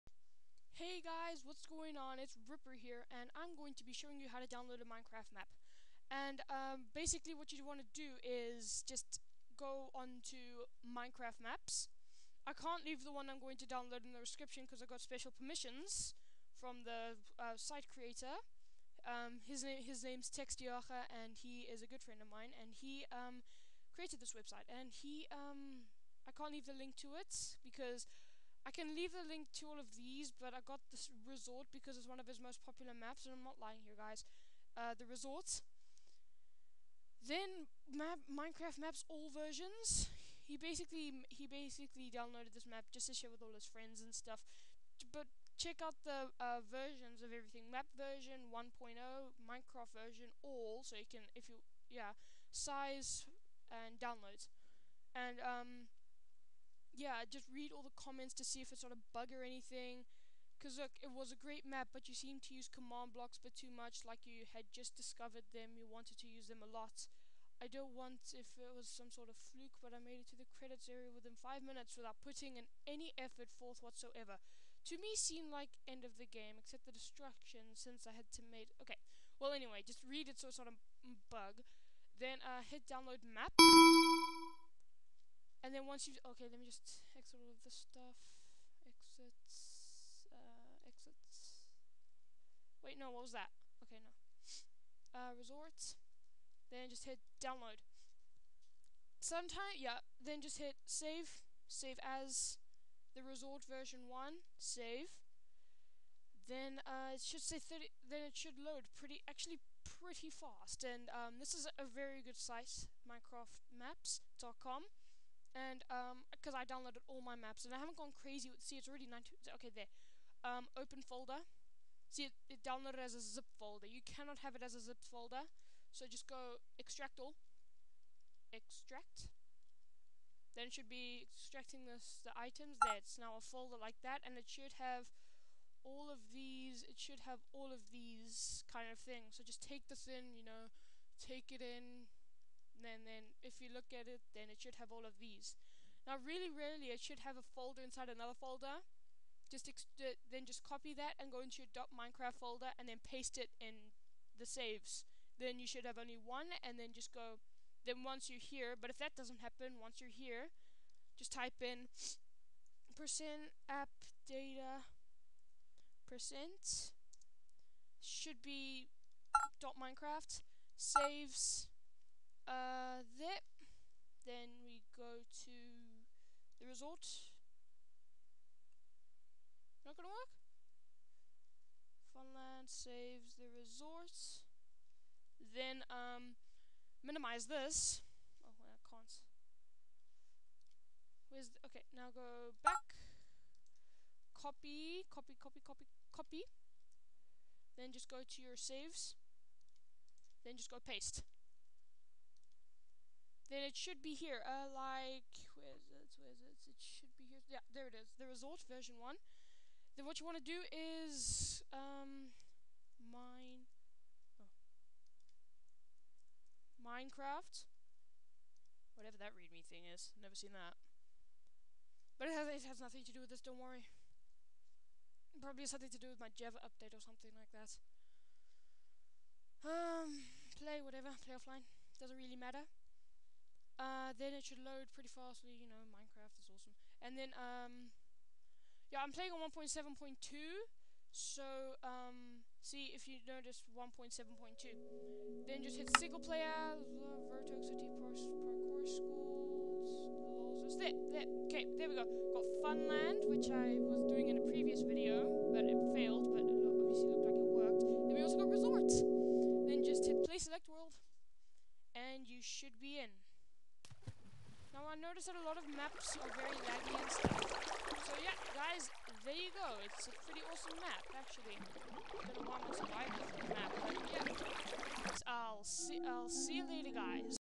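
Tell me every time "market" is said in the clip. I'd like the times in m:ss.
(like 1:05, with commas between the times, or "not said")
not said.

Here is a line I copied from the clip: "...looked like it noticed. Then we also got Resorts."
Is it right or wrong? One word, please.
wrong.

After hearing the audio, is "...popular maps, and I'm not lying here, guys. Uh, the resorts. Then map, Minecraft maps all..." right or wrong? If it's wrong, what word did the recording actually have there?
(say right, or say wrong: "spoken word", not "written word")
right.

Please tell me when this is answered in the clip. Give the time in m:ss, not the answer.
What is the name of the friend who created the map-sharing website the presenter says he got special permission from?
0:20.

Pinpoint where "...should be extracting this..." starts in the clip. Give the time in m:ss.
2:10.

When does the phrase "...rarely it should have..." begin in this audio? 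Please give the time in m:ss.
2:26.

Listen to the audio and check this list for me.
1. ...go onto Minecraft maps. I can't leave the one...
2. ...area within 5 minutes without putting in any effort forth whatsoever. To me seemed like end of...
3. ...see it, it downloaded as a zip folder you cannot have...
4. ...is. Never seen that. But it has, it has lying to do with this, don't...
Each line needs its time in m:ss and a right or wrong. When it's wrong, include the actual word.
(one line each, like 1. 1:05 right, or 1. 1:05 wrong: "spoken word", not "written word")
1. 0:09 right
2. 1:10 right
3. 2:02 right
4. 3:39 wrong: "nothing", not "lying".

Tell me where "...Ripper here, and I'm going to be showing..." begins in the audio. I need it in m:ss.
0:02.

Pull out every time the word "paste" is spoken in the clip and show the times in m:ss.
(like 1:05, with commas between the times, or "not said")
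2:33, 3:20.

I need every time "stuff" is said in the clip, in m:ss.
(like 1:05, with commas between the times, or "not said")
0:44, 1:27, 4:27.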